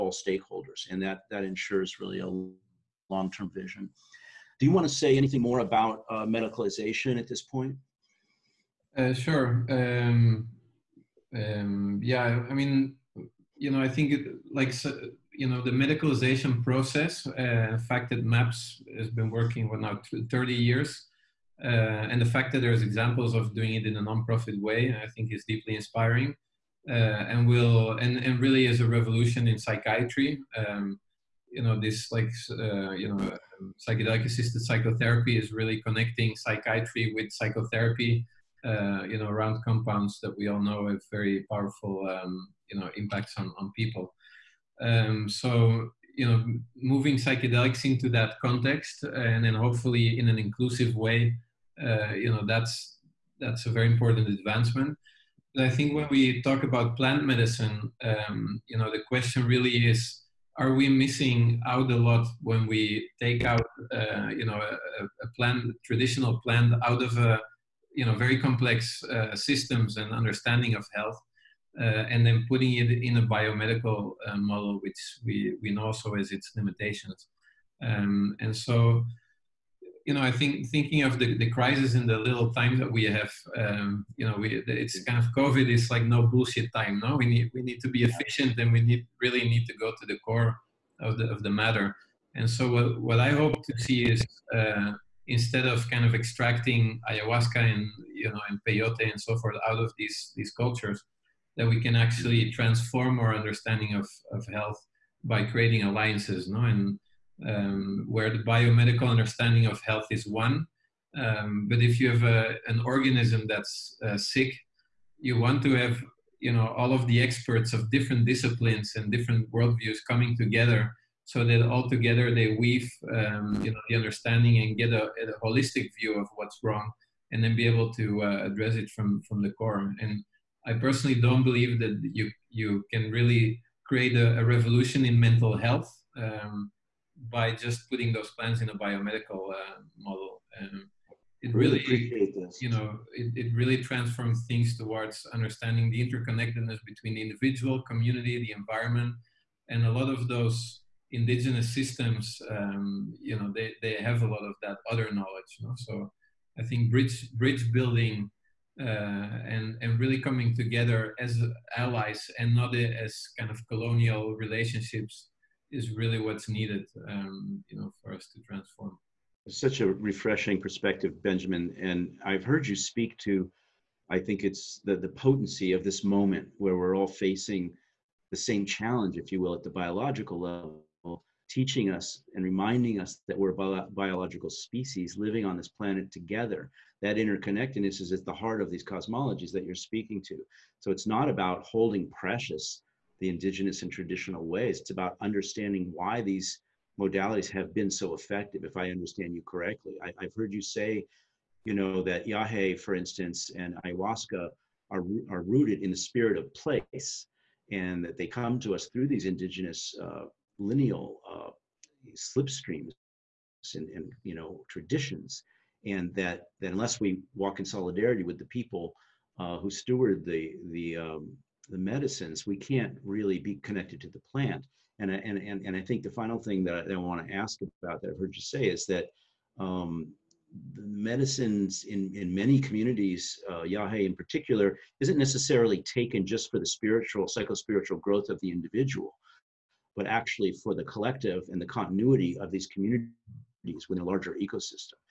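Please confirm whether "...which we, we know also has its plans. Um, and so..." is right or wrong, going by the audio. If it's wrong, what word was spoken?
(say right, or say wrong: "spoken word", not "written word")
wrong: "limitations", not "plans".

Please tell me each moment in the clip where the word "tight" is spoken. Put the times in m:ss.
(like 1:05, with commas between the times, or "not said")
not said.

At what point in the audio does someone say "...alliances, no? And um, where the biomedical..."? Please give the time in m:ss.
1:45.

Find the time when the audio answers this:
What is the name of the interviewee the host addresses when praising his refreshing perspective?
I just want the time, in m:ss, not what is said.
2:51.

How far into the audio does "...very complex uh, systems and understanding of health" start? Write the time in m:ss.
1:08.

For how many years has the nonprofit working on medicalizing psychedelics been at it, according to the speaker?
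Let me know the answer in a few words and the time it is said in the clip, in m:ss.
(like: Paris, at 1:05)
30 years, at 0:20.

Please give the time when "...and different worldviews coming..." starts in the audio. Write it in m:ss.
1:58.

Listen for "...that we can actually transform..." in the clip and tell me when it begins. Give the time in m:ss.
1:41.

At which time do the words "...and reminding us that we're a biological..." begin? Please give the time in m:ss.
3:02.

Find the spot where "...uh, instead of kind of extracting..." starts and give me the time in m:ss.
1:34.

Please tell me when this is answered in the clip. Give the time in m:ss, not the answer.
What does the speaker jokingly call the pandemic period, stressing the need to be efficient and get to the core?
1:26.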